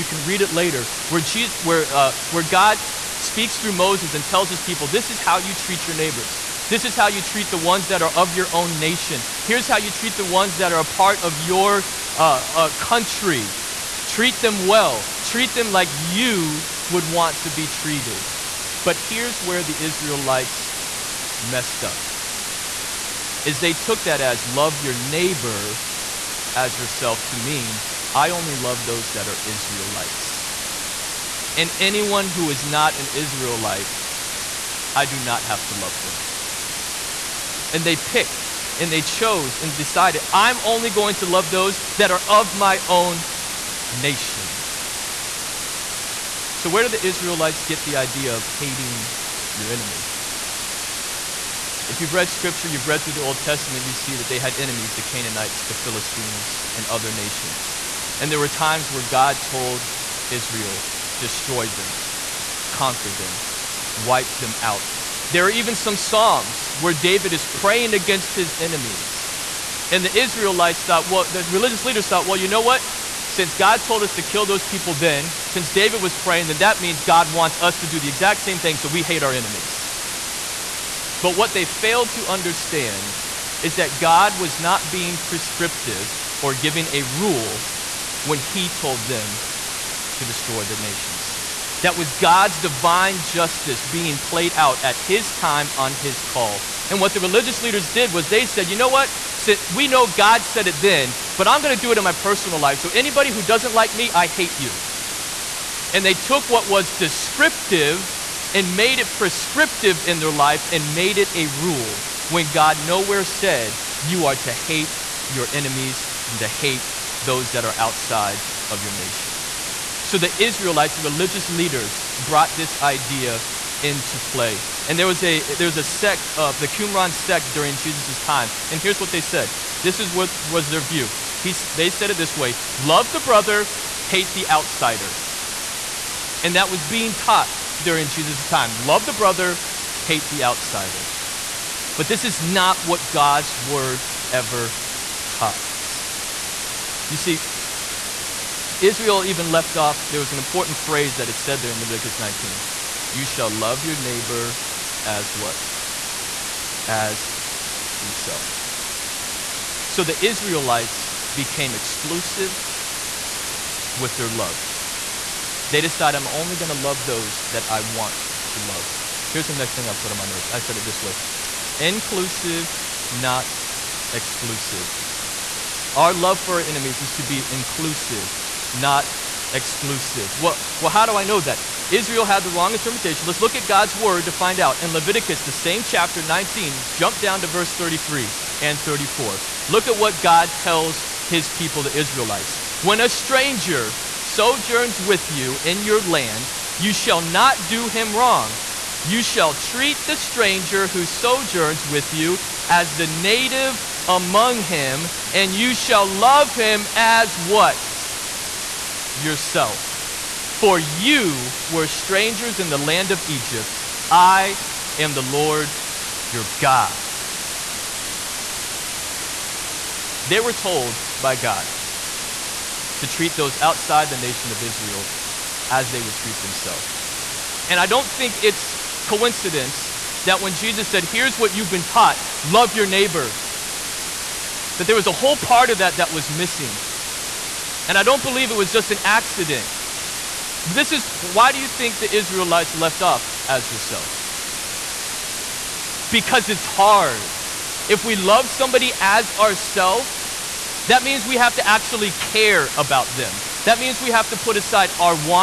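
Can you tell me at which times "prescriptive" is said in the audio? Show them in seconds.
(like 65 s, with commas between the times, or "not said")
85 s, 109 s.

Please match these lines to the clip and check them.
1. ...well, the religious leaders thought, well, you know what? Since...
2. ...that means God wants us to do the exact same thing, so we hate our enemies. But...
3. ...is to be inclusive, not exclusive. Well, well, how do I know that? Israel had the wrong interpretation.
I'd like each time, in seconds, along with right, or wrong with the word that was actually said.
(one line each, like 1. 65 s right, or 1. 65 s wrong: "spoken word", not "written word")
1. 71 s right
2. 76 s right
3. 177 s right.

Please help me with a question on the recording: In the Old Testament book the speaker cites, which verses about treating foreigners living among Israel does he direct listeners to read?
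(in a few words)
33 and 34.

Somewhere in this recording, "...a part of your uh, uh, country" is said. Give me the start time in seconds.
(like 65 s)
10 s.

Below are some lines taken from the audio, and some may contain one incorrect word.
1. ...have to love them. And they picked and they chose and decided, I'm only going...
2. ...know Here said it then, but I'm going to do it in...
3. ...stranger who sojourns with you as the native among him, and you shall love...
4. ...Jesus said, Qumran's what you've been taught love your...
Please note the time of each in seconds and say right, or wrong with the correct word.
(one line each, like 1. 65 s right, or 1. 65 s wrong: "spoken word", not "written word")
1. 35 s right
2. 99 s wrong: "God", not "Here"
3. 200 s right
4. 230 s wrong: "Here", not "Qumran".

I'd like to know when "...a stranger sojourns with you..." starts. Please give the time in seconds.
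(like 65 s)
192 s.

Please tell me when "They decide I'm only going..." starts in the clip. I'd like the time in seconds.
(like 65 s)
165 s.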